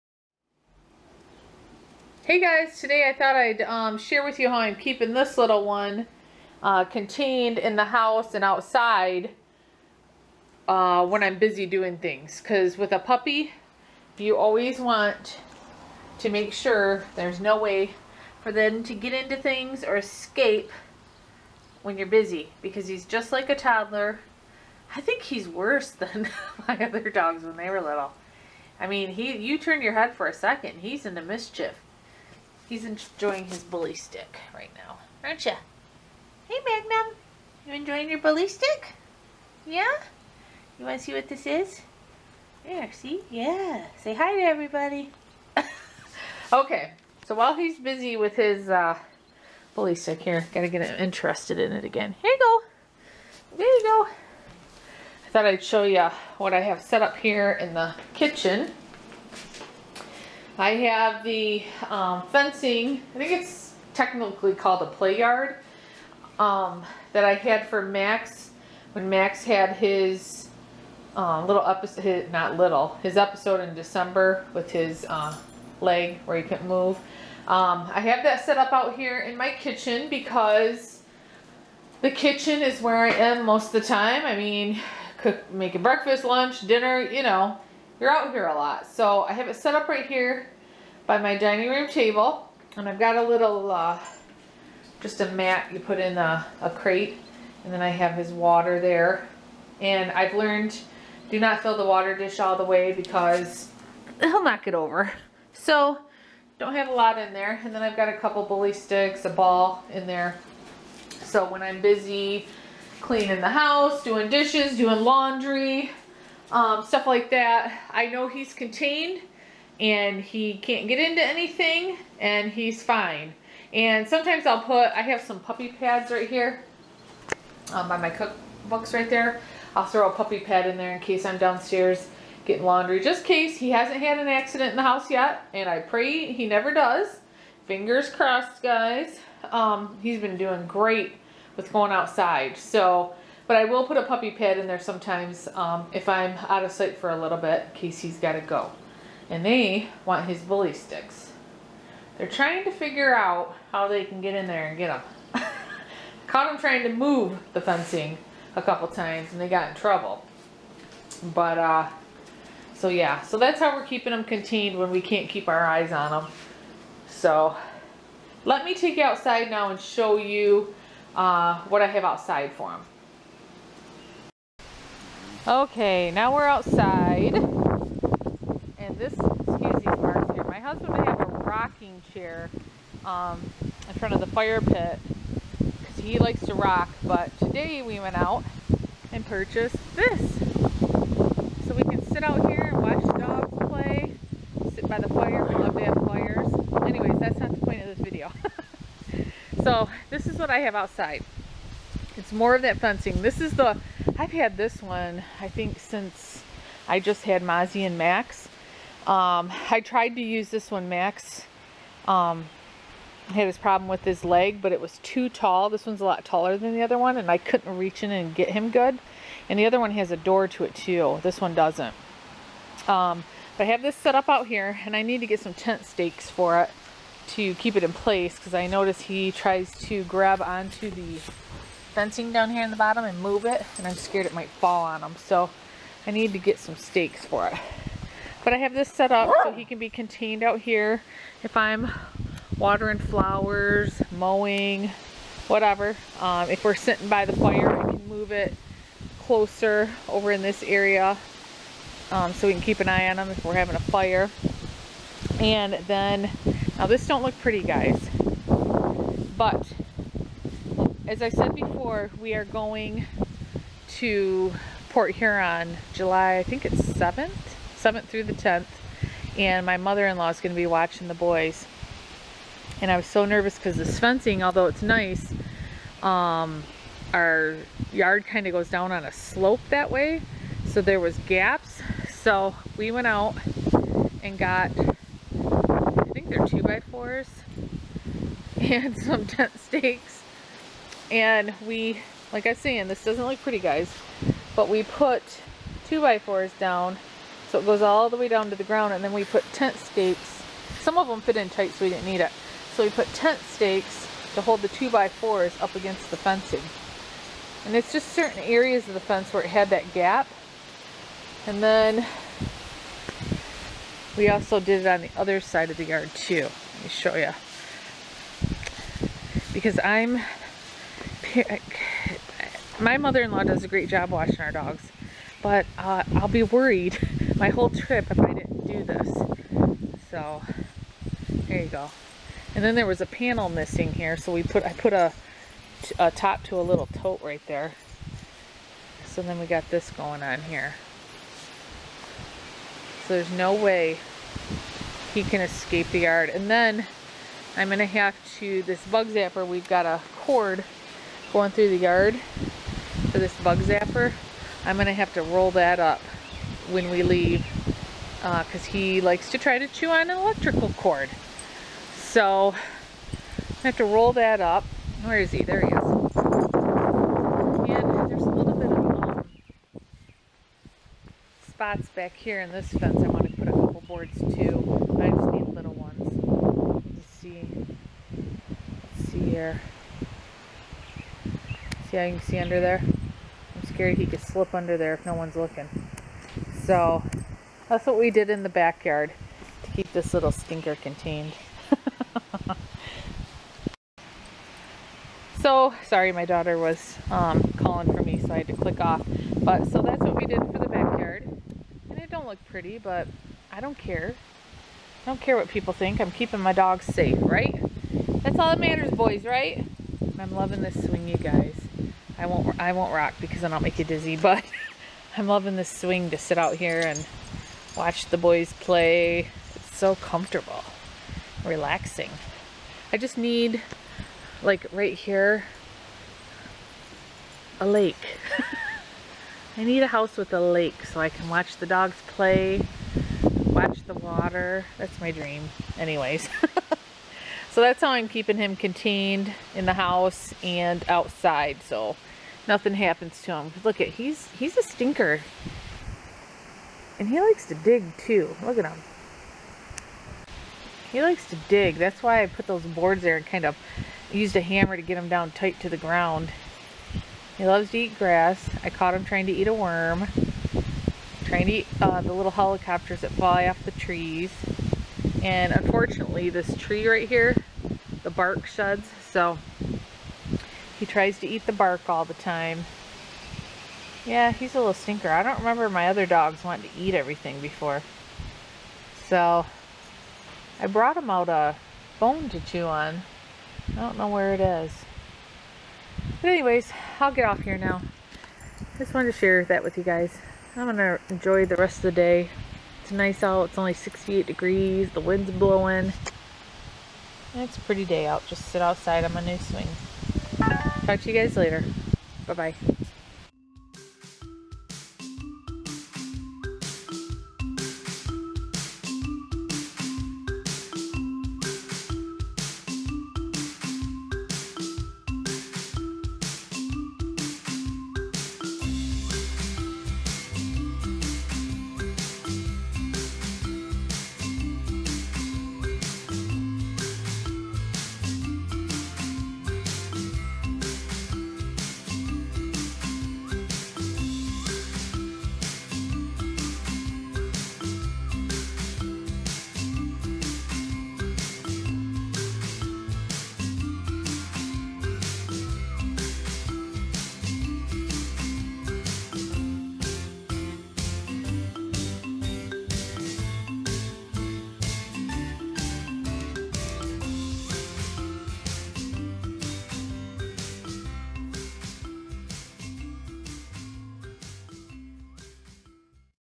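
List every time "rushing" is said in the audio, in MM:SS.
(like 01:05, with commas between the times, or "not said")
not said.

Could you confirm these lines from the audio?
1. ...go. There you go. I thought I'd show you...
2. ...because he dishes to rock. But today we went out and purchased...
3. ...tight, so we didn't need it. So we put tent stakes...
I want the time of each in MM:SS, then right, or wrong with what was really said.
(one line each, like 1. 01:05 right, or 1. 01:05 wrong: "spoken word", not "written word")
1. 00:52 right
2. 03:05 wrong: "likes", not "dishes"
3. 05:01 right.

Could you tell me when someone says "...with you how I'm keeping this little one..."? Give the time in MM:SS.
00:04.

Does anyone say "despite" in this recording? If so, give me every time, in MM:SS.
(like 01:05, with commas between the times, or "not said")
not said.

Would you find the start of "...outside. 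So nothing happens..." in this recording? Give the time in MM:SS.
07:20.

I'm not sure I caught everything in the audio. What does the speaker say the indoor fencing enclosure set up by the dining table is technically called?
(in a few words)
play yard.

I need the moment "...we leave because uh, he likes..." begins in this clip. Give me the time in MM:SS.
05:56.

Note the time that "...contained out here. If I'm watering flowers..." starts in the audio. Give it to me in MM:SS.
03:59.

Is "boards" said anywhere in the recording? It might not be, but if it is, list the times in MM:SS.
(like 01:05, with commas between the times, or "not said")
06:13, 07:32.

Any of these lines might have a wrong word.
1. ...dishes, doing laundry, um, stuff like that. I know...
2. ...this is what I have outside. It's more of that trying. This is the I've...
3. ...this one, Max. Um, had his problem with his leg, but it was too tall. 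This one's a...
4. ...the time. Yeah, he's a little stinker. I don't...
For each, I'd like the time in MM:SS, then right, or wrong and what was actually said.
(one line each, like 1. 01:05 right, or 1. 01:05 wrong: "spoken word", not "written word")
1. 01:54 right
2. 03:20 wrong: "fencing", not "trying"
3. 03:30 right
4. 07:52 right.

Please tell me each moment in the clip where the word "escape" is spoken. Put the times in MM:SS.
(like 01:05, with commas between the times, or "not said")
00:19, 05:45.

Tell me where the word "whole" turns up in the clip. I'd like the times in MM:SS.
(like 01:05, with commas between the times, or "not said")
05:27.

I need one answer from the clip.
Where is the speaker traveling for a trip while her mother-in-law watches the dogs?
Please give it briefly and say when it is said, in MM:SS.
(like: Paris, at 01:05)
Port Huron, at 04:24.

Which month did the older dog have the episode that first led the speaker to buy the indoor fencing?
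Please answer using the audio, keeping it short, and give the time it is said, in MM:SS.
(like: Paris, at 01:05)
December, at 01:13.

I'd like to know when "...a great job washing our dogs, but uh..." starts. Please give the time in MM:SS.
05:23.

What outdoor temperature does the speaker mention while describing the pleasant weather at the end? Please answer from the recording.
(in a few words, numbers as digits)
68 degrees.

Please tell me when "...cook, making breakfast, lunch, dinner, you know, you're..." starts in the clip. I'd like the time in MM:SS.
01:25.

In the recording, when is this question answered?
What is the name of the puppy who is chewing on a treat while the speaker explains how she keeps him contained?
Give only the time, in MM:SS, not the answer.
00:36.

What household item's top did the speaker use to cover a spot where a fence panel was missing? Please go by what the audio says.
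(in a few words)
tote.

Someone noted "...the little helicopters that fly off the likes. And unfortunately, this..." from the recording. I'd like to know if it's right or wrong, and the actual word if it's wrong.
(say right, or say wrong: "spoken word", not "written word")
wrong: "trees", not "likes".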